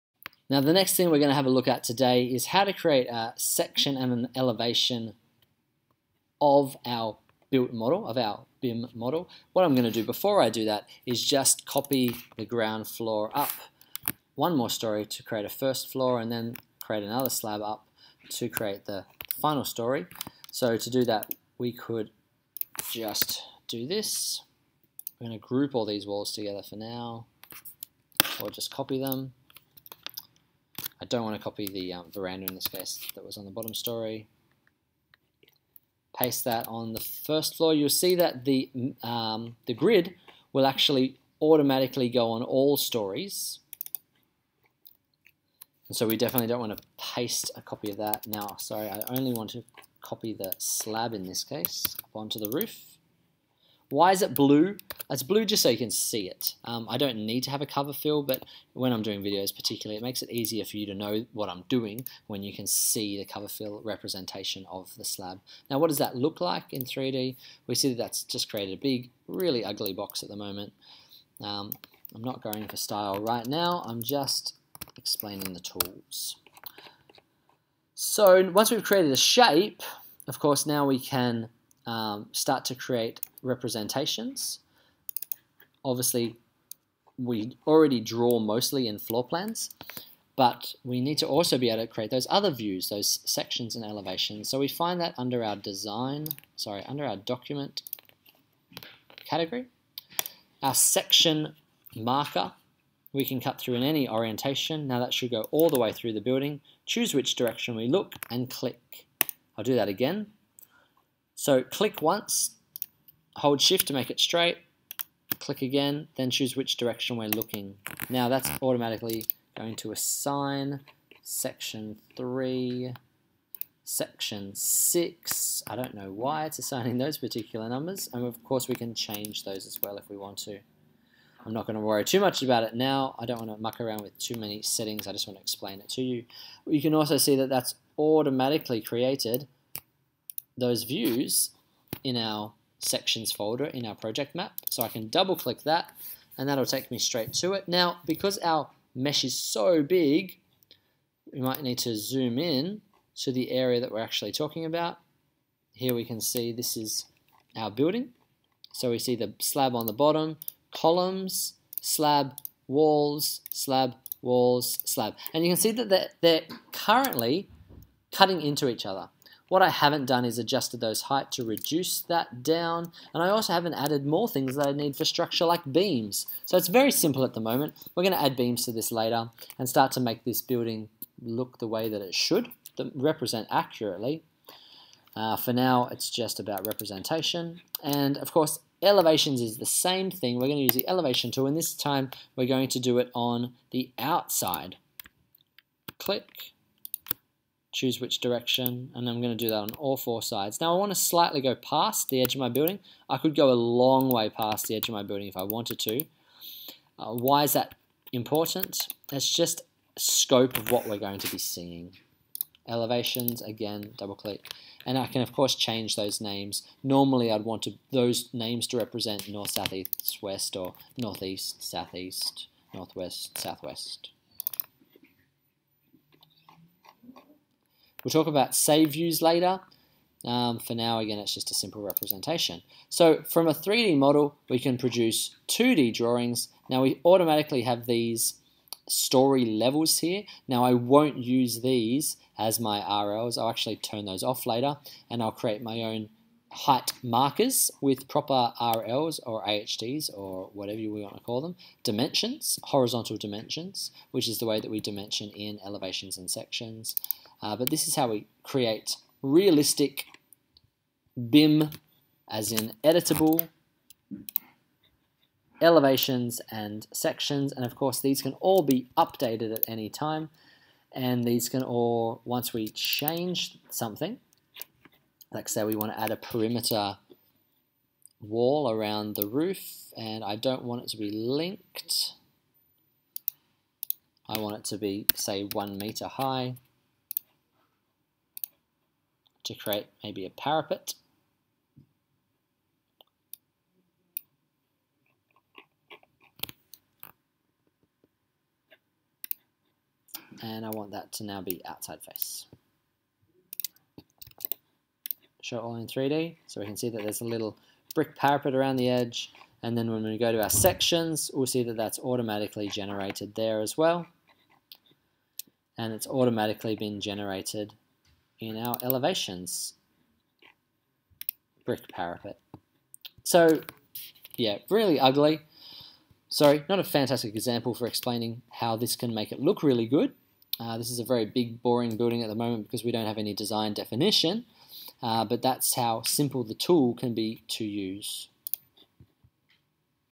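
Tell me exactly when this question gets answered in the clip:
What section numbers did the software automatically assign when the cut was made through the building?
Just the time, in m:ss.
2:02.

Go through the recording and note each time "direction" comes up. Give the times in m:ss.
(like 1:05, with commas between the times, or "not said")
1:47, 1:56, 3:18.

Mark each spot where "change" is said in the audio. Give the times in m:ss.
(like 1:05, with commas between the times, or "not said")
2:08, 3:35, 4:32.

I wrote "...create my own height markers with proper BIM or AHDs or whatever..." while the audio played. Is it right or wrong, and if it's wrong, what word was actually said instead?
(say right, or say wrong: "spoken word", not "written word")
wrong: "RLs", not "BIM".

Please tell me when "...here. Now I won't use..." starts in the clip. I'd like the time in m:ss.
3:59.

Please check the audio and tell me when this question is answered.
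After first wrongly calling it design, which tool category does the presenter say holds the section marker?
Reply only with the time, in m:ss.
1:37.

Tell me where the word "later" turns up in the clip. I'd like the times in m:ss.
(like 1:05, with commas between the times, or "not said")
2:58, 3:49, 4:04.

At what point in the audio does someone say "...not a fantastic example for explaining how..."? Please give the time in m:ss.
5:26.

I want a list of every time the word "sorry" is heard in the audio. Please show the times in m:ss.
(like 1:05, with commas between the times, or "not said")
0:48, 1:36, 5:26.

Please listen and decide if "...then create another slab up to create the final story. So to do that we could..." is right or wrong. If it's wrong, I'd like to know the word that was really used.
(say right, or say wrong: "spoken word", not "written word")
right.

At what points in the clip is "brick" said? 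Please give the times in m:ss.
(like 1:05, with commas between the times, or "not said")
5:07, 5:21.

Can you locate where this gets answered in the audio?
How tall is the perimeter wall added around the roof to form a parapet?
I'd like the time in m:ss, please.
4:45.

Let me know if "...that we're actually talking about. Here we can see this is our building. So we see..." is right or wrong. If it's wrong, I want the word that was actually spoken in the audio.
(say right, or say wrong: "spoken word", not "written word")
right.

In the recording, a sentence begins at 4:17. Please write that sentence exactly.
Uh, but this is how we create realistic BIM, as in editable, elevations and sections.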